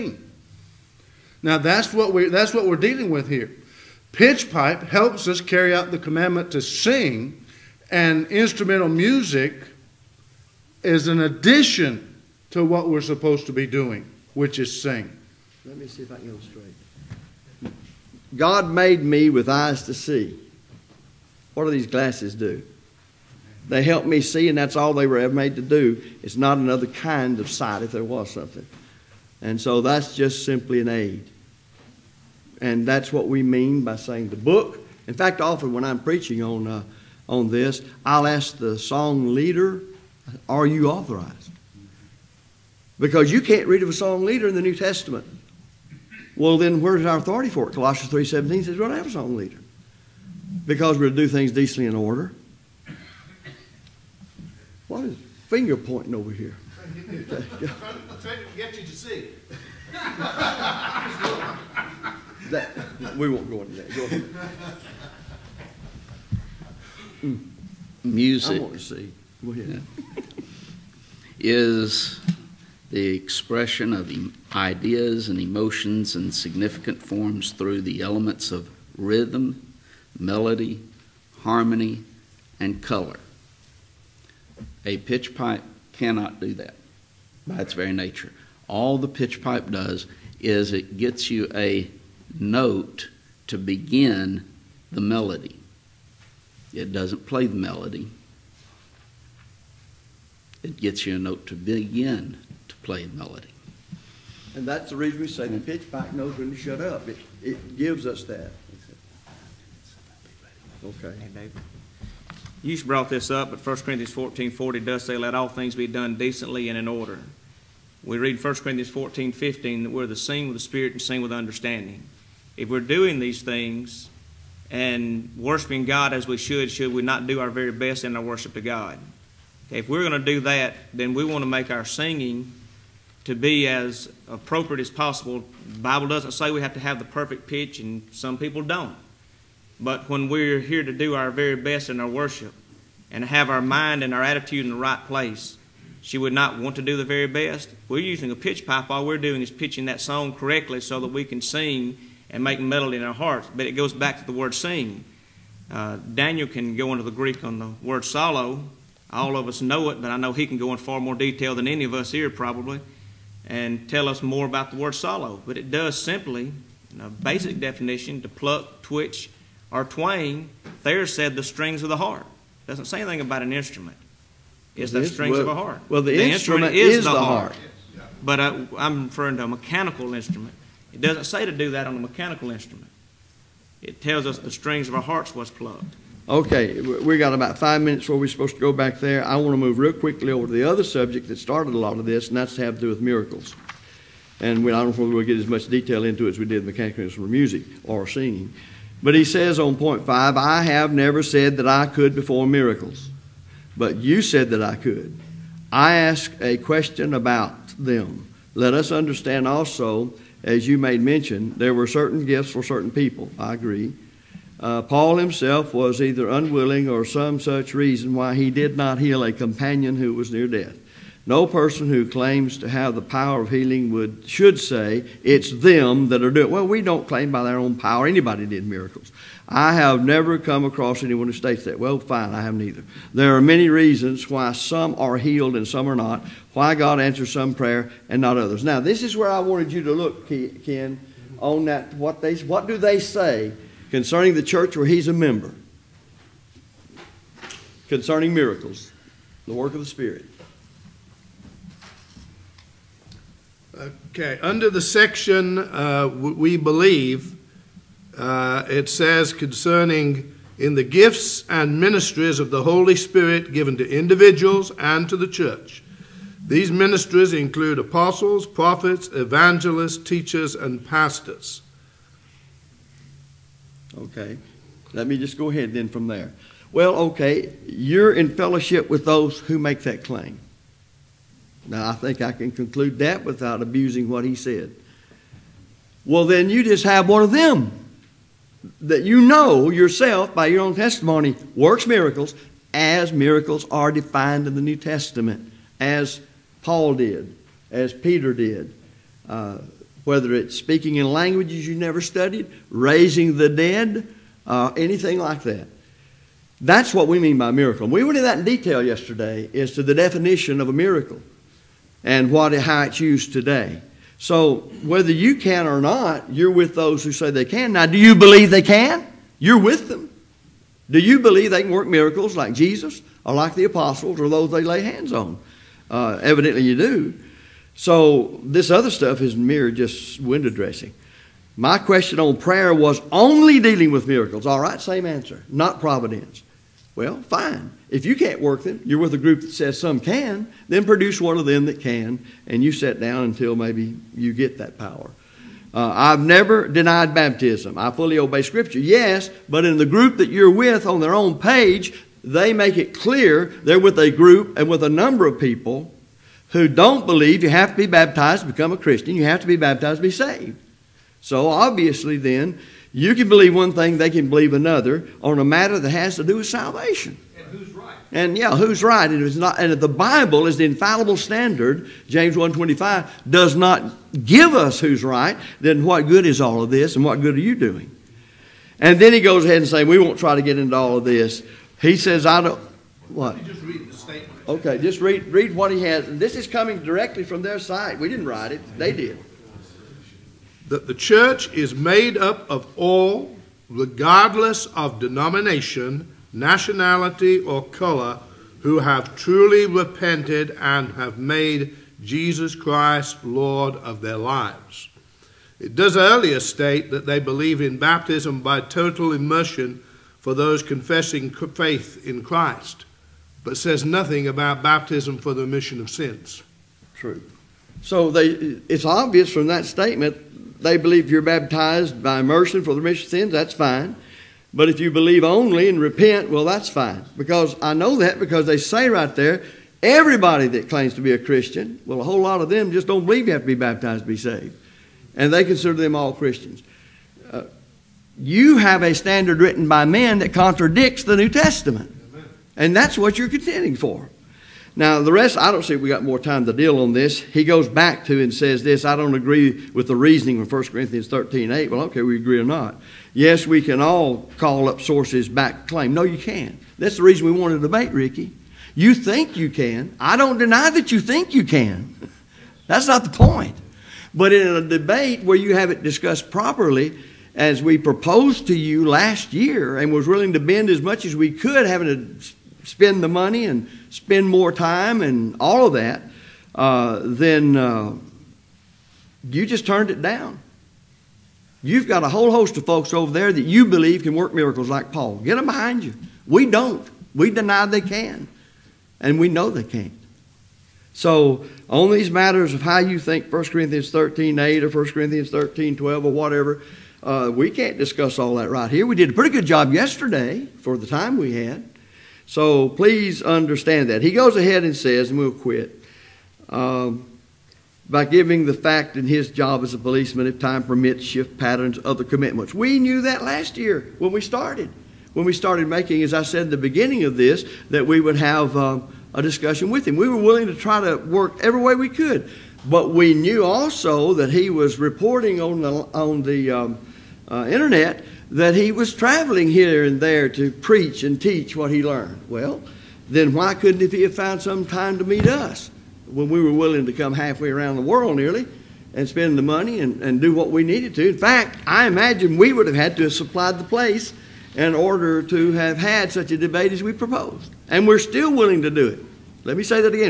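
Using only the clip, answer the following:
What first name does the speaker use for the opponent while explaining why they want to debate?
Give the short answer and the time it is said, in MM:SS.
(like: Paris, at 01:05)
Ricky, at 07:37.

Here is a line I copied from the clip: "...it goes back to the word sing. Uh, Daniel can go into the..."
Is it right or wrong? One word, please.
right.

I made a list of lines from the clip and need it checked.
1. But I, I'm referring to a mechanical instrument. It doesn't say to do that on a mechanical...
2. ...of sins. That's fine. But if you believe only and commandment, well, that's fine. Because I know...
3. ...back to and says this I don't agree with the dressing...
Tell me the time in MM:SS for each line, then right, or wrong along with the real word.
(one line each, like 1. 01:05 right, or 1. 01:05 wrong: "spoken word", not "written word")
1. 02:58 right
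2. 07:03 wrong: "repent", not "commandment"
3. 07:27 wrong: "reasoning", not "dressing".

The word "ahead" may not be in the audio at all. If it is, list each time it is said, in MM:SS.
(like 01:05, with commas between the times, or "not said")
01:04, 01:09, 04:35, 06:19, 08:24.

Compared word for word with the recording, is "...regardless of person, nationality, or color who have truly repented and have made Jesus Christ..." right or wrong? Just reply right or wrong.
wrong.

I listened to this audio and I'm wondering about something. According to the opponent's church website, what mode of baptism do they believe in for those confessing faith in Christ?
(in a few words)
Total immersion.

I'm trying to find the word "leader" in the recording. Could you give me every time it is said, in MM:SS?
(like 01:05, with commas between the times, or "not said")
00:39, 00:44, 00:49.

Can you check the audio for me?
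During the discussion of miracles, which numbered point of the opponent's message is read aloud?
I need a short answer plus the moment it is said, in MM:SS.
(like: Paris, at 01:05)
Point 5, at 03:19.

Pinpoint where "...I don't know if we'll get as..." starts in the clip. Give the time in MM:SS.
03:14.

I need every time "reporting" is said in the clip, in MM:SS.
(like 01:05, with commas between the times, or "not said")
08:44.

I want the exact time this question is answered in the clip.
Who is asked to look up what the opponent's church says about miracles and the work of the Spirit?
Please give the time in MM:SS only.
04:00.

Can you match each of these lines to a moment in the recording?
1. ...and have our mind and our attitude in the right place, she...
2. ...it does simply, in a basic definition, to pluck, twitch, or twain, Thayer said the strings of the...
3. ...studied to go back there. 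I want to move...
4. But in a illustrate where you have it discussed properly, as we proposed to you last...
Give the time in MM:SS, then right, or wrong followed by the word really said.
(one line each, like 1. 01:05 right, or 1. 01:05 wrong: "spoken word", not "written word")
1. 02:23 right
2. 02:45 right
3. 03:08 wrong: "supposed", not "studied"
4. 07:44 wrong: "debate", not "illustrate".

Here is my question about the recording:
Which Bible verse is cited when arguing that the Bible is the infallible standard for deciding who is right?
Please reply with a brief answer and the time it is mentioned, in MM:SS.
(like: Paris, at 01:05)
James 1:25, at 06:12.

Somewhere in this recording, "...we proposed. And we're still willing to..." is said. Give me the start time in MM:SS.
09:06.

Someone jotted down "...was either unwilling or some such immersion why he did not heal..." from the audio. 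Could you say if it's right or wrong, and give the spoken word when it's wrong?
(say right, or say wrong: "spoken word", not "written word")
wrong: "reason", not "immersion".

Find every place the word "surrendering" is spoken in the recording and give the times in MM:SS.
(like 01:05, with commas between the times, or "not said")
not said.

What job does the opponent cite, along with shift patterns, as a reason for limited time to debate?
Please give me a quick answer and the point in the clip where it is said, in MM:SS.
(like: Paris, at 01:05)
Policeman, at 08:29.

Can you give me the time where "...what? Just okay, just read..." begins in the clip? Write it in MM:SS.
06:23.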